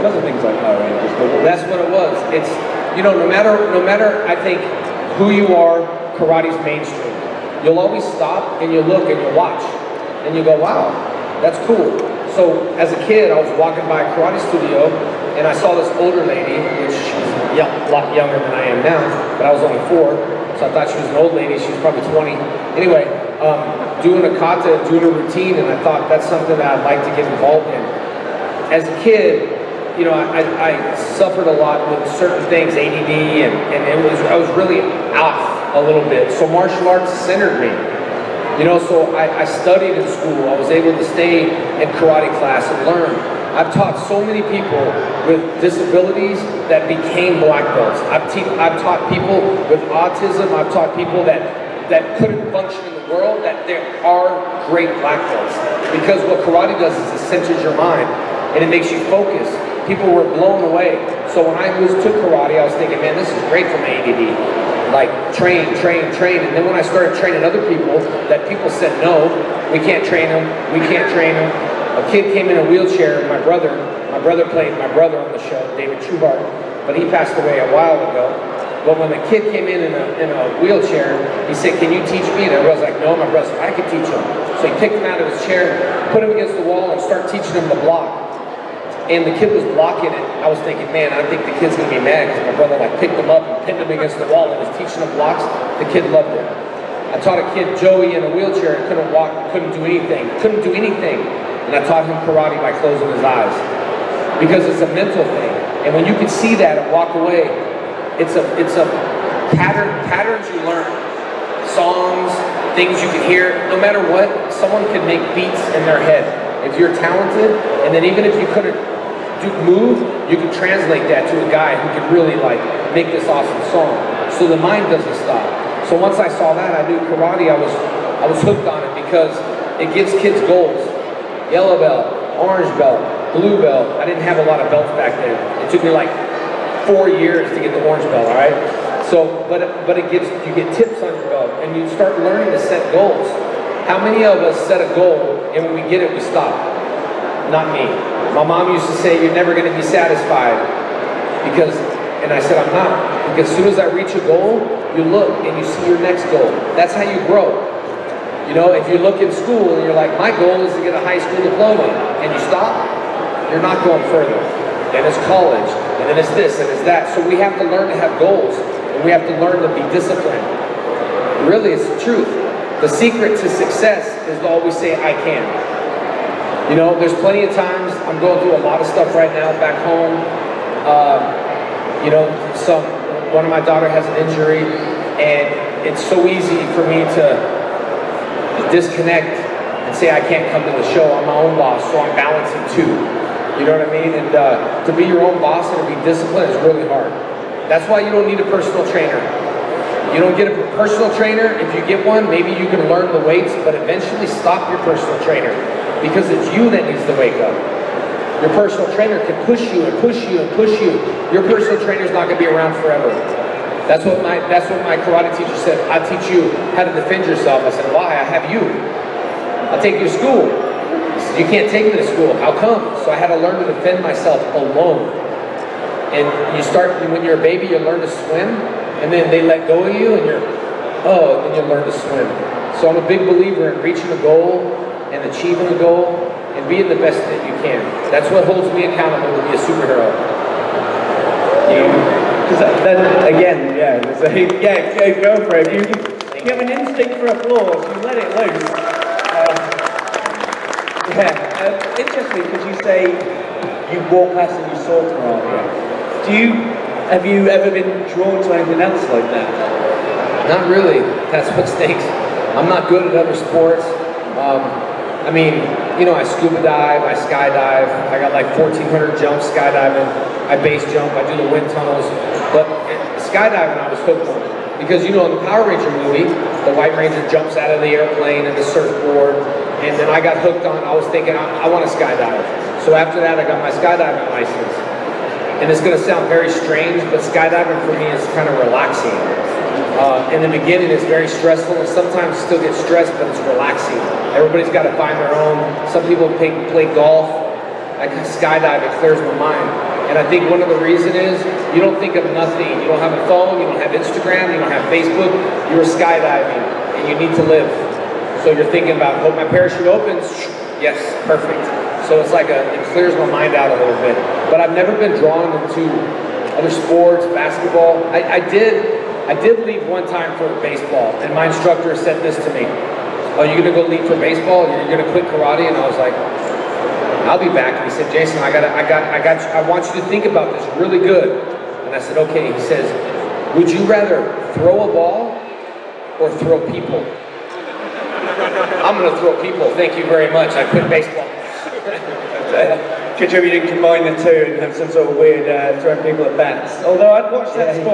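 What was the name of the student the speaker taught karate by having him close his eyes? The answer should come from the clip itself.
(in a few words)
Joey.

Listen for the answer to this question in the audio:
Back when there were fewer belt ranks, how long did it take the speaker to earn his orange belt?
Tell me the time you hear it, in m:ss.
2:16.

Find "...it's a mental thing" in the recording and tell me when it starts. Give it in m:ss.
1:44.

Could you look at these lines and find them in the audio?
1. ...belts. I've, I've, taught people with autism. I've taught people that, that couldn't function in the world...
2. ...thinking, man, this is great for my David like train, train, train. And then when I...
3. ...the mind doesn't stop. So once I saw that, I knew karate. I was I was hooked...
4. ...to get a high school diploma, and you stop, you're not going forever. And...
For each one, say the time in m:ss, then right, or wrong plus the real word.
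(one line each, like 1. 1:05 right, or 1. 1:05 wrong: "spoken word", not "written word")
1. 0:47 right
2. 1:02 wrong: "ADD", not "David"
3. 2:04 right
4. 2:40 wrong: "further", not "forever".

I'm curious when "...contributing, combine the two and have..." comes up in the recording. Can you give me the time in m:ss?
5:43.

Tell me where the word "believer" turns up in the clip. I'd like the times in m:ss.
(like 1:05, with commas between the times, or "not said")
3:53.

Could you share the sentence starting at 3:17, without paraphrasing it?
That's why you don't need a personal trainer.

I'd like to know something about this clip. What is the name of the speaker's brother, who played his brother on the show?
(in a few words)
David Trueheart.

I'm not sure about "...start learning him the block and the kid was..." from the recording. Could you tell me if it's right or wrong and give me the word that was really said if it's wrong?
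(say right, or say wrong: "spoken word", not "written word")
wrong: "teaching", not "learning".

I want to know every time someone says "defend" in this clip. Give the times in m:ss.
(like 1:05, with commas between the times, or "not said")
3:36, 3:43.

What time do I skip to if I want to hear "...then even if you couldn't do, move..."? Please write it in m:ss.
1:57.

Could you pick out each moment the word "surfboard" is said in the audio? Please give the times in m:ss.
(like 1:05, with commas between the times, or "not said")
4:38.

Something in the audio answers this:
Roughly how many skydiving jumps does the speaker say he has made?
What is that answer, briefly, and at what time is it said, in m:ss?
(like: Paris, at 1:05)
1,400, at 4:28.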